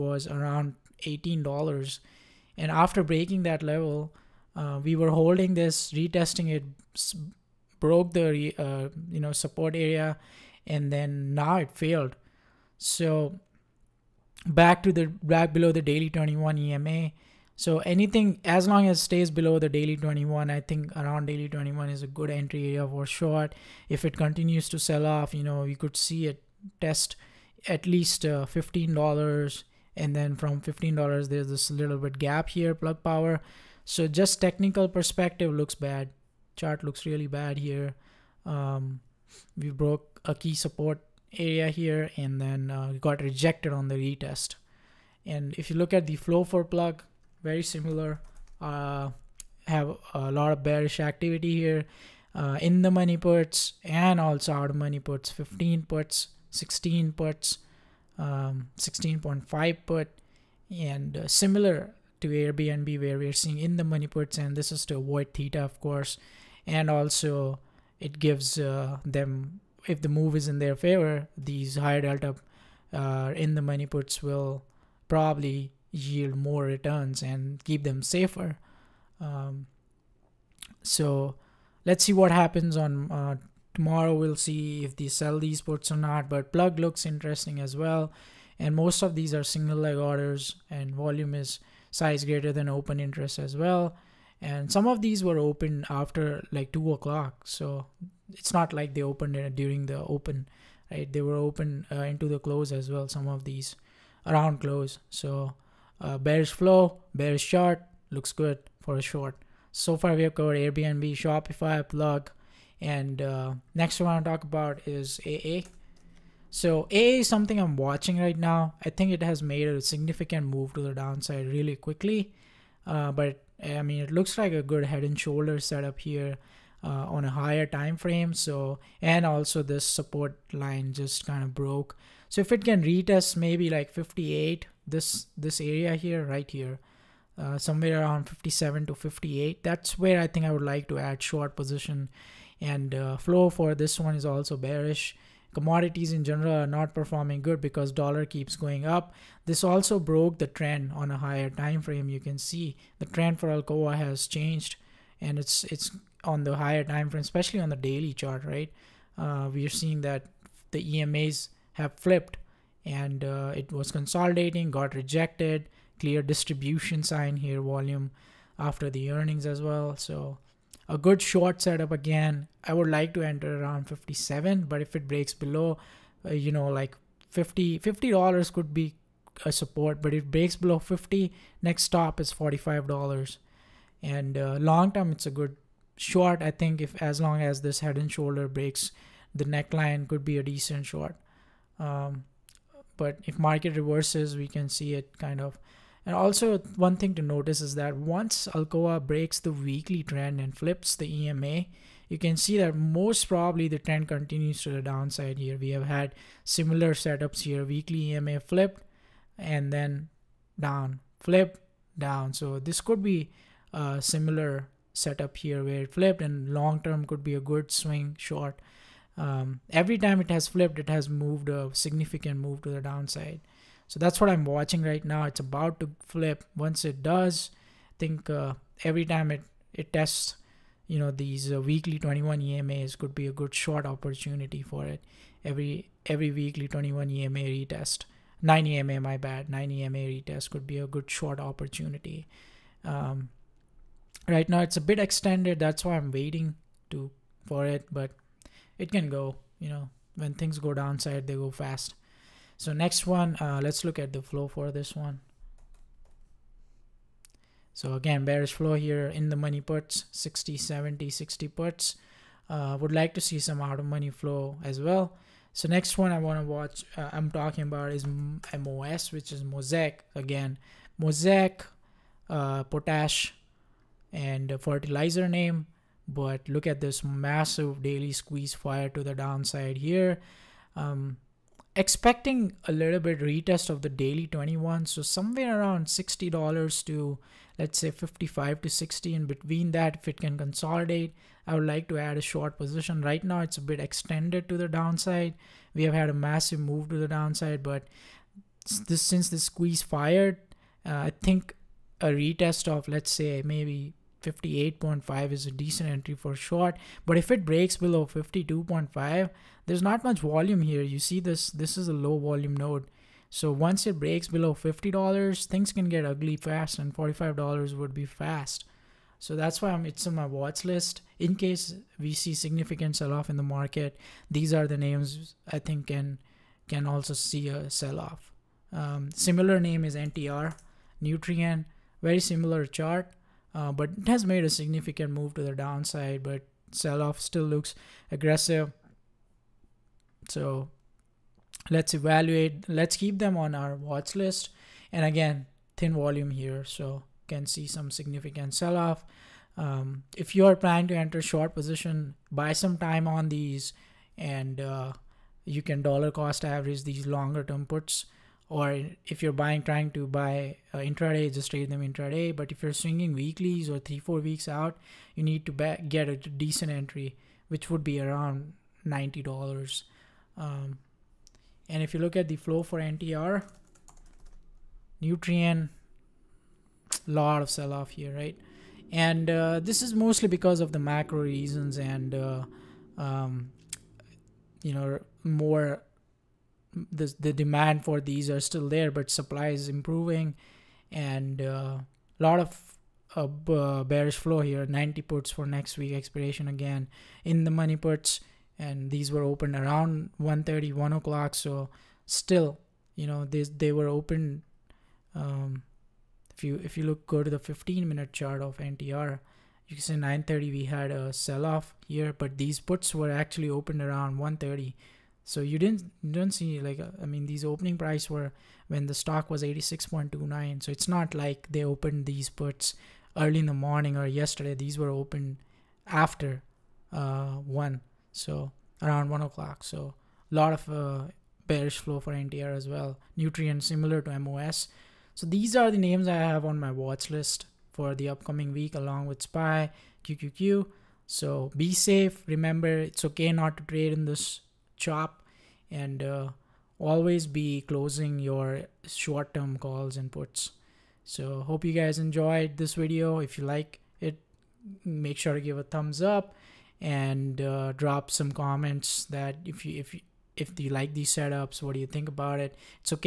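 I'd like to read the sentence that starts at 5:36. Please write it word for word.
But sell off still looks aggressive.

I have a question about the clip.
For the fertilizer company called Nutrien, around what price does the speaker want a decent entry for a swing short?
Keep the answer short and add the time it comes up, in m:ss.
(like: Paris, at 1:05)
$90, at 6:07.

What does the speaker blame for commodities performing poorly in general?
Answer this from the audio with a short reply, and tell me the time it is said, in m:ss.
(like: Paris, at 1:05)
Dollar keeps going up, at 2:27.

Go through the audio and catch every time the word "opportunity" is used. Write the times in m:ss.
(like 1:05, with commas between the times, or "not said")
3:53, 4:01.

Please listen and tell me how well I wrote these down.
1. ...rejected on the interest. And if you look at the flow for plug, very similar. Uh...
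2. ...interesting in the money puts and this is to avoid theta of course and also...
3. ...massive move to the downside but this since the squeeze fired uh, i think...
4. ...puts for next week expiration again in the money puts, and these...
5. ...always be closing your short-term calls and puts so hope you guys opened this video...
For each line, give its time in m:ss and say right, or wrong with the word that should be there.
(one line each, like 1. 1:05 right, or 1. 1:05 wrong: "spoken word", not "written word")
1. 0:43 wrong: "retest", not "interest"
2. 1:03 wrong: "seeing", not "interesting"
3. 4:56 right
4. 6:35 right
5. 7:26 wrong: "enjoyed", not "opened".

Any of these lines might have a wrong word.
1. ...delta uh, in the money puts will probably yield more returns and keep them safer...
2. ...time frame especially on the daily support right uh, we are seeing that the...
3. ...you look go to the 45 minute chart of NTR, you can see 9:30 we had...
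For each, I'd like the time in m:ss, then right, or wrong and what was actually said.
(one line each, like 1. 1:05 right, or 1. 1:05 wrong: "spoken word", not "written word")
1. 1:12 right
2. 2:36 wrong: "chart", not "support"
3. 6:46 wrong: "15", not "45".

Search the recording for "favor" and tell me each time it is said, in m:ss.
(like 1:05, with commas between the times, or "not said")
1:10.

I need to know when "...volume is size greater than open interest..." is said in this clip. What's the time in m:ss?
1:30.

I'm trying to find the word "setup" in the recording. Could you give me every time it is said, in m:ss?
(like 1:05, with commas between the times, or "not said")
2:05, 2:51, 3:26, 3:34, 7:41.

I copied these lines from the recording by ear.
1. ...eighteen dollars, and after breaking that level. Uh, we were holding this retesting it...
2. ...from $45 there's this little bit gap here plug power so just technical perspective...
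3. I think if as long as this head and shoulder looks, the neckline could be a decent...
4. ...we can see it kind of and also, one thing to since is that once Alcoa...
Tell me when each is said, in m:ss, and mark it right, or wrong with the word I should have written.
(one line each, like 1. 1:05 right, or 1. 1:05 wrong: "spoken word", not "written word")
1. 0:01 right
2. 0:30 wrong: "15", not "45"
3. 3:06 wrong: "breaks", not "looks"
4. 3:14 wrong: "notice", not "since".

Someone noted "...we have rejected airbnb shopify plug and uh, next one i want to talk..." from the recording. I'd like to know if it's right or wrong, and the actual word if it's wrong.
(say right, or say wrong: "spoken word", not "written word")
wrong: "covered", not "rejected".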